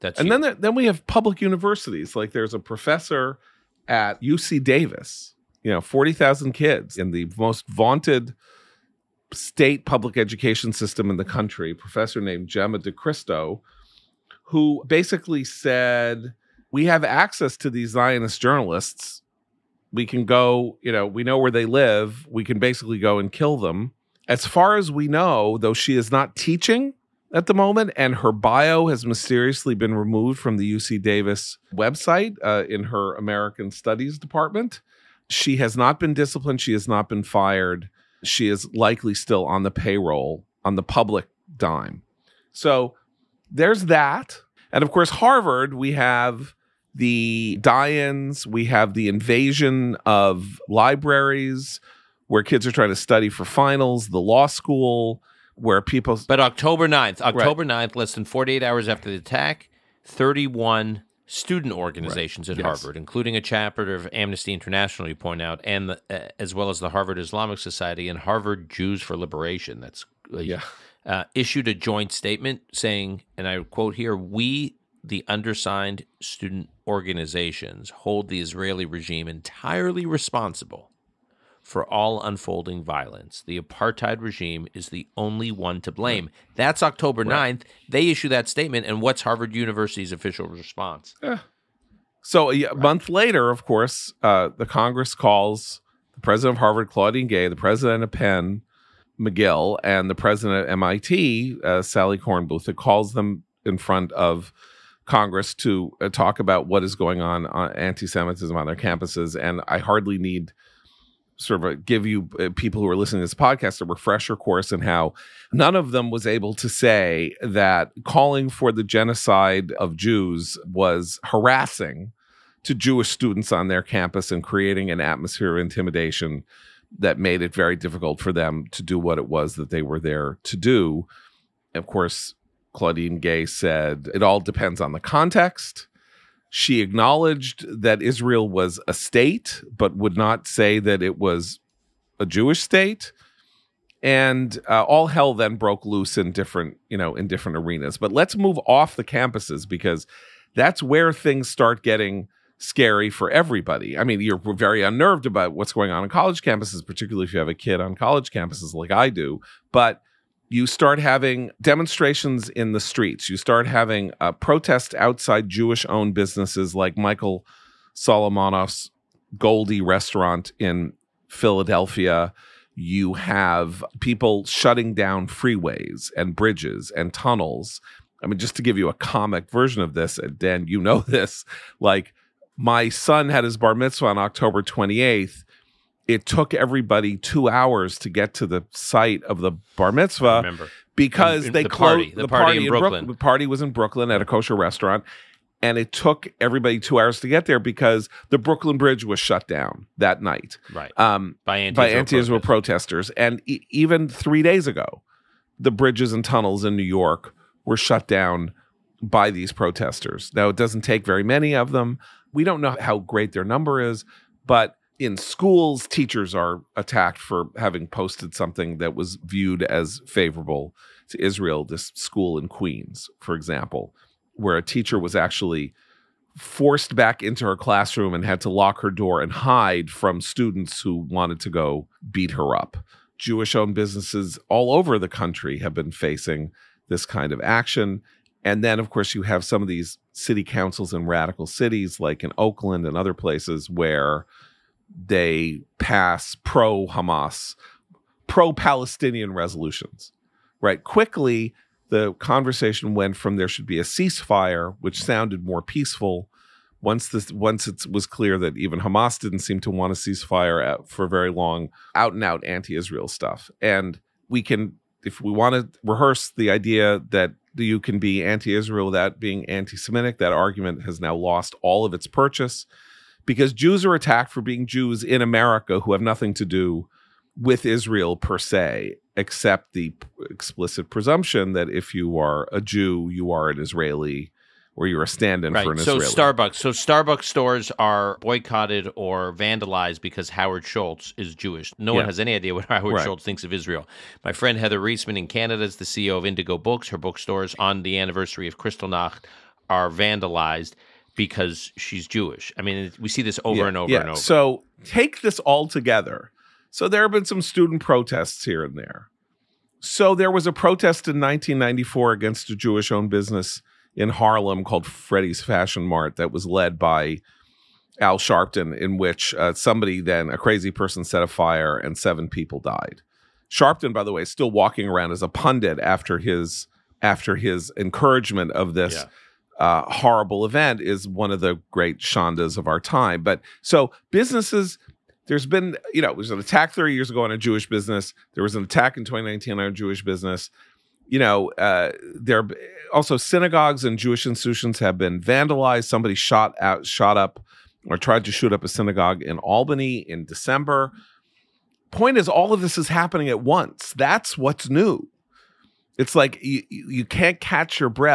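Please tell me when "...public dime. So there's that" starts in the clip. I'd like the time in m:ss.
0:40.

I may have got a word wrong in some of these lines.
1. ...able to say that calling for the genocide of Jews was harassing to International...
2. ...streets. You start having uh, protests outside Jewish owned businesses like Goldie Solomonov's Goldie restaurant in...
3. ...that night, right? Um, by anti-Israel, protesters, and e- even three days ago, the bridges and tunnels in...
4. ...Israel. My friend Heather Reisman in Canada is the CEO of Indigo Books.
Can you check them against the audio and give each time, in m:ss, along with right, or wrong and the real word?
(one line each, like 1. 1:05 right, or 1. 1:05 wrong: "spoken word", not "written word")
1. 1:56 wrong: "Jewish", not "International"
2. 2:42 wrong: "Michael", not "Goldie"
3. 3:19 right
4. 4:53 right.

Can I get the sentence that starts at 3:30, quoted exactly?
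Now it doesn't take very many of them.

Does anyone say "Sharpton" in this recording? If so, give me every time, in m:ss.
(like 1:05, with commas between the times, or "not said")
5:18, 5:23.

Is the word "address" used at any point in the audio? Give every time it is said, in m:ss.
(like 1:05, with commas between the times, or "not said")
not said.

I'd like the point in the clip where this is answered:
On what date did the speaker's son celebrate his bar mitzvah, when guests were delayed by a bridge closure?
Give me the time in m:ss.
3:04.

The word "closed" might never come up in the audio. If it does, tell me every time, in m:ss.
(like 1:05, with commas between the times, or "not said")
3:11.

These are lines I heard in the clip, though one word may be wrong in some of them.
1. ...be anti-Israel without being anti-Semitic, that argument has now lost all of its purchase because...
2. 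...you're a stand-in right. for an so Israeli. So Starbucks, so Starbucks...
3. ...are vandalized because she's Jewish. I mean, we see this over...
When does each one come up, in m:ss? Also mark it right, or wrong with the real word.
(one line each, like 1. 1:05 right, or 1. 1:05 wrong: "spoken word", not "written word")
1. 4:27 right
2. 4:44 right
3. 4:59 right.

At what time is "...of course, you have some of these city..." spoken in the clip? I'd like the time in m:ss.
3:58.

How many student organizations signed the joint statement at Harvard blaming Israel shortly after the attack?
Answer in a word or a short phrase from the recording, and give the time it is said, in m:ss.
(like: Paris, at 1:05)
31, at 1:00.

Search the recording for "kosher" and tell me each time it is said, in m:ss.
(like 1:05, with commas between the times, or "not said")
3:14.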